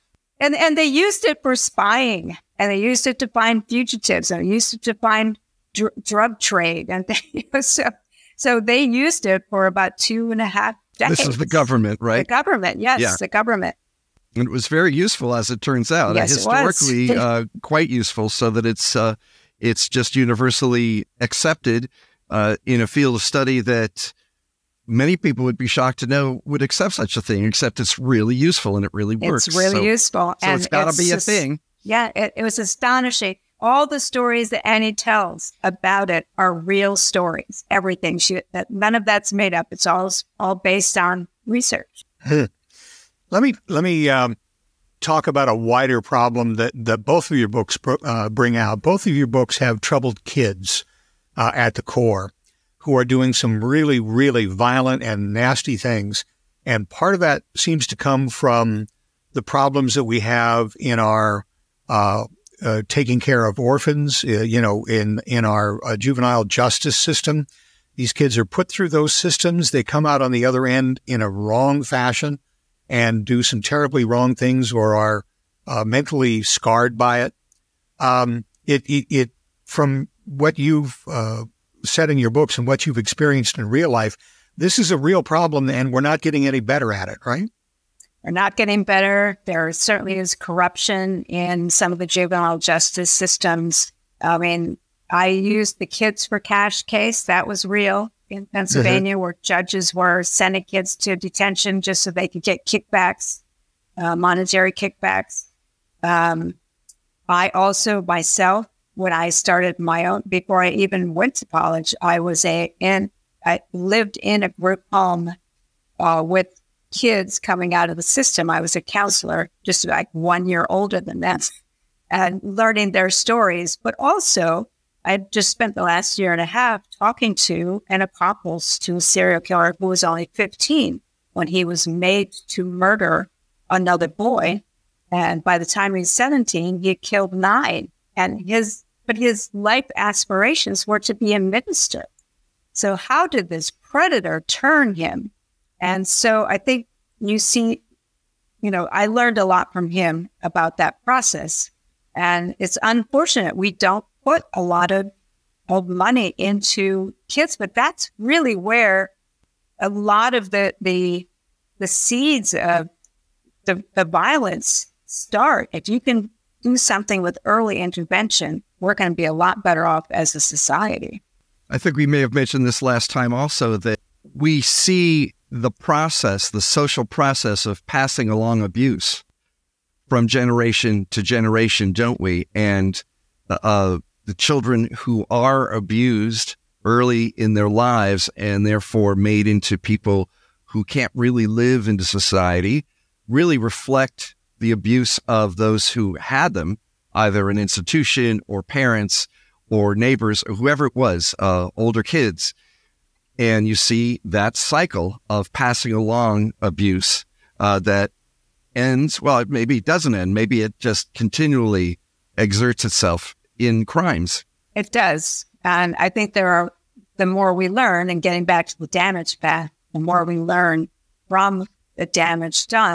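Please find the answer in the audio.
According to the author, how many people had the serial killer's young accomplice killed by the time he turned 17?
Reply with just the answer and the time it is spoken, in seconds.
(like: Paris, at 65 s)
9, at 137 s.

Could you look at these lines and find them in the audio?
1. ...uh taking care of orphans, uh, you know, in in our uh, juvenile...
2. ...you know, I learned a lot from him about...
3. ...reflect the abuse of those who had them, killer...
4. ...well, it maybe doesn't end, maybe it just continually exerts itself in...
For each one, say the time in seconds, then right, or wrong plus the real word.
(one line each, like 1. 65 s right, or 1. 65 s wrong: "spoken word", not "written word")
1. 62 s right
2. 148 s right
3. 193 s wrong: "either", not "killer"
4. 209 s right.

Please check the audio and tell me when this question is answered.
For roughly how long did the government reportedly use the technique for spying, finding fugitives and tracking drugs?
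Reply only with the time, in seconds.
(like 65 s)
9 s.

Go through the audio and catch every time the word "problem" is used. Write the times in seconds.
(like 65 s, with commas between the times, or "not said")
46 s, 59 s, 85 s.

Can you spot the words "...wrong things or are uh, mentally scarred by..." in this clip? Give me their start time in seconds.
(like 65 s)
74 s.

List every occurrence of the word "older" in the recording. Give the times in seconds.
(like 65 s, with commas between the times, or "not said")
120 s, 201 s.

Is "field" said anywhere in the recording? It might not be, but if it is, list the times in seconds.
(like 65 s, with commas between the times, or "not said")
22 s.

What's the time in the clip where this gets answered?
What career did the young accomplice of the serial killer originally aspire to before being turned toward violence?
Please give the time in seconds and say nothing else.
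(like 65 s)
141 s.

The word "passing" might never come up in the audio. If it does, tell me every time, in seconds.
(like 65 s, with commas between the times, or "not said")
177 s, 205 s.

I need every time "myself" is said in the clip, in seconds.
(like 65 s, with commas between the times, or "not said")
108 s.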